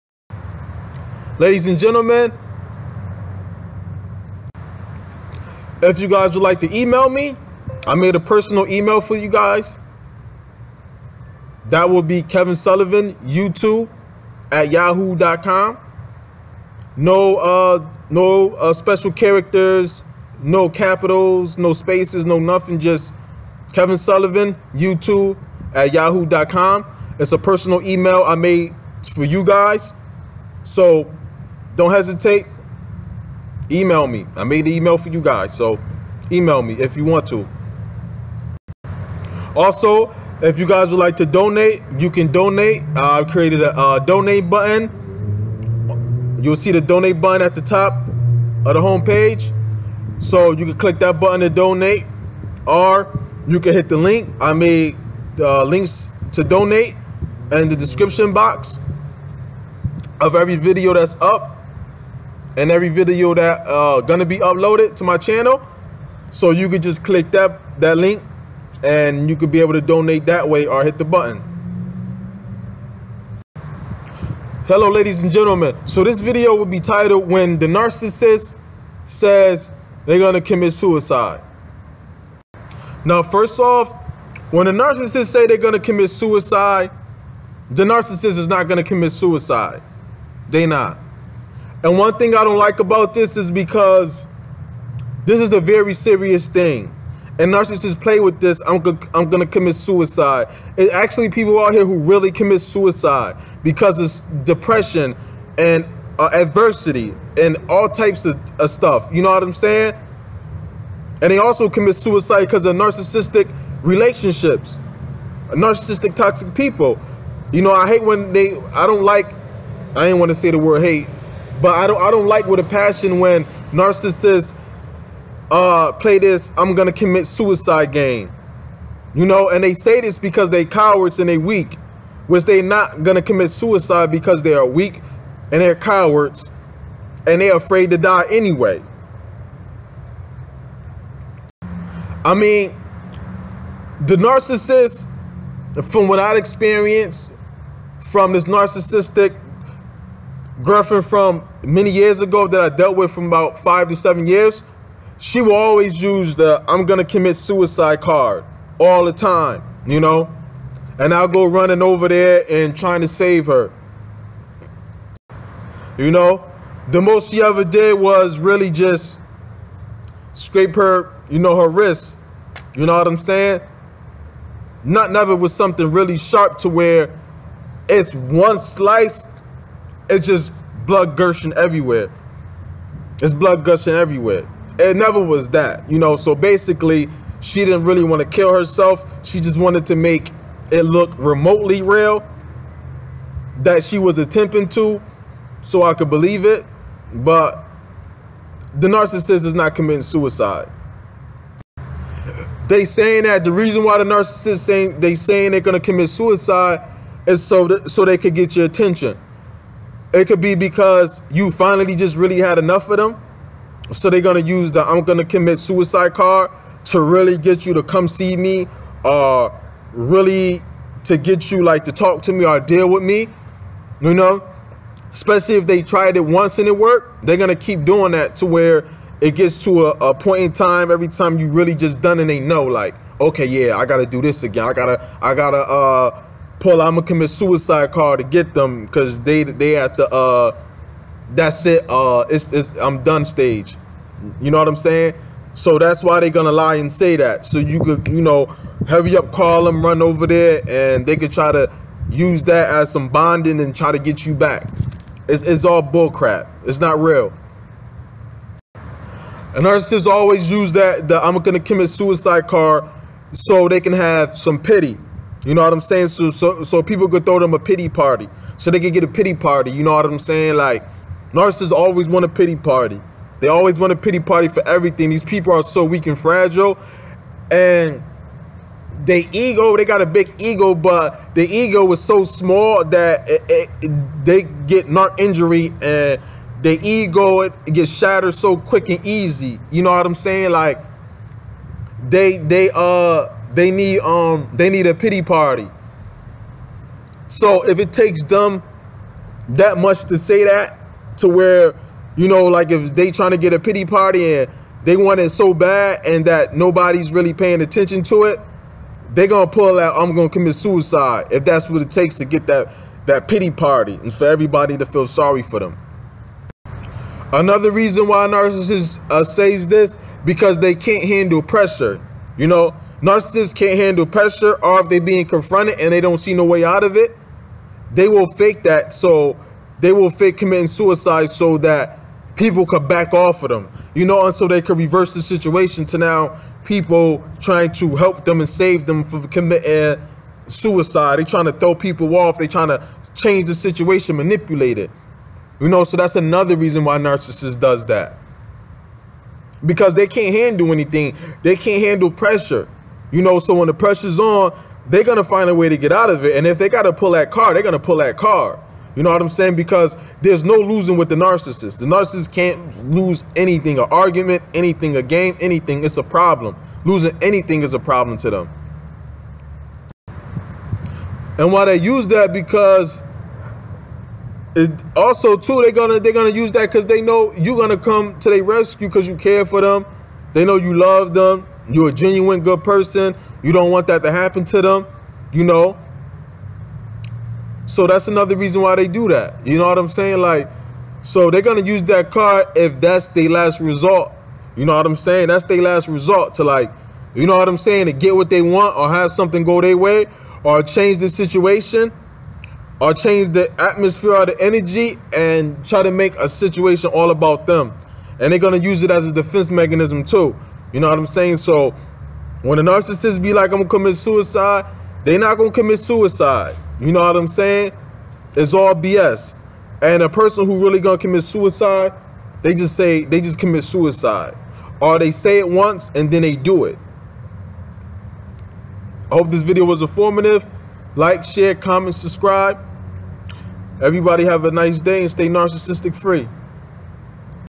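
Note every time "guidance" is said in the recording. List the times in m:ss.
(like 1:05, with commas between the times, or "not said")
not said.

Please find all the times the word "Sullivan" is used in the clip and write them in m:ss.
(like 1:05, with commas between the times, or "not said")
0:12, 0:23.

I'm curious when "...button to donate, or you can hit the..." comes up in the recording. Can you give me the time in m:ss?
0:51.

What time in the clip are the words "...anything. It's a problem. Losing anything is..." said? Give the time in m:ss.
6:05.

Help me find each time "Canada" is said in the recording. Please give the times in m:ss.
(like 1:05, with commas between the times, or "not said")
not said.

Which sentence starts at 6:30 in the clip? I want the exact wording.
Like, so they're going to use that card if that's their last resort.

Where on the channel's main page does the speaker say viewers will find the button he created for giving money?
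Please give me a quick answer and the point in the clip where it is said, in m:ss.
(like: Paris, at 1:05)
Top of the homepage, at 0:47.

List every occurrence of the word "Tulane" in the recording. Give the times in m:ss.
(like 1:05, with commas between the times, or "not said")
not said.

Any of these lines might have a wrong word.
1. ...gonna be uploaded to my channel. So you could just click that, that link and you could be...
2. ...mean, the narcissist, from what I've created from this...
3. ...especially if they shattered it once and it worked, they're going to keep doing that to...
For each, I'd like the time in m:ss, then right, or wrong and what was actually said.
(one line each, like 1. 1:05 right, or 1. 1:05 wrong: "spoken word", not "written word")
1. 1:04 right
2. 2:22 wrong: "experienced", not "created"
3. 3:45 wrong: "tried", not "shattered".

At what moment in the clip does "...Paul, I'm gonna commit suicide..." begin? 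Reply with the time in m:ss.
3:56.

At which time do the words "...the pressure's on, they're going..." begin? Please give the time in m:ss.
5:53.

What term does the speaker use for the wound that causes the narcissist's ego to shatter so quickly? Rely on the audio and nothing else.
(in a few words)
Narc injury.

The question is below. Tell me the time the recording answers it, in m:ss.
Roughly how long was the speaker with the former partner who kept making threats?
2:33.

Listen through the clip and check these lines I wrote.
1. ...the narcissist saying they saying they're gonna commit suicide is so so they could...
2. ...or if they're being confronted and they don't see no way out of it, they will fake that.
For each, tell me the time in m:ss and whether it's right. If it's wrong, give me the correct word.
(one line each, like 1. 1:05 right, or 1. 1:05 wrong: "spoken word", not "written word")
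1. 3:23 right
2. 5:24 right.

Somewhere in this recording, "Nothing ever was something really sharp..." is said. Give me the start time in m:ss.
2:54.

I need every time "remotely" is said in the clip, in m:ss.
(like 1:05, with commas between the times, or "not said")
3:11.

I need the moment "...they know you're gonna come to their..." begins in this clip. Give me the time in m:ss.
6:16.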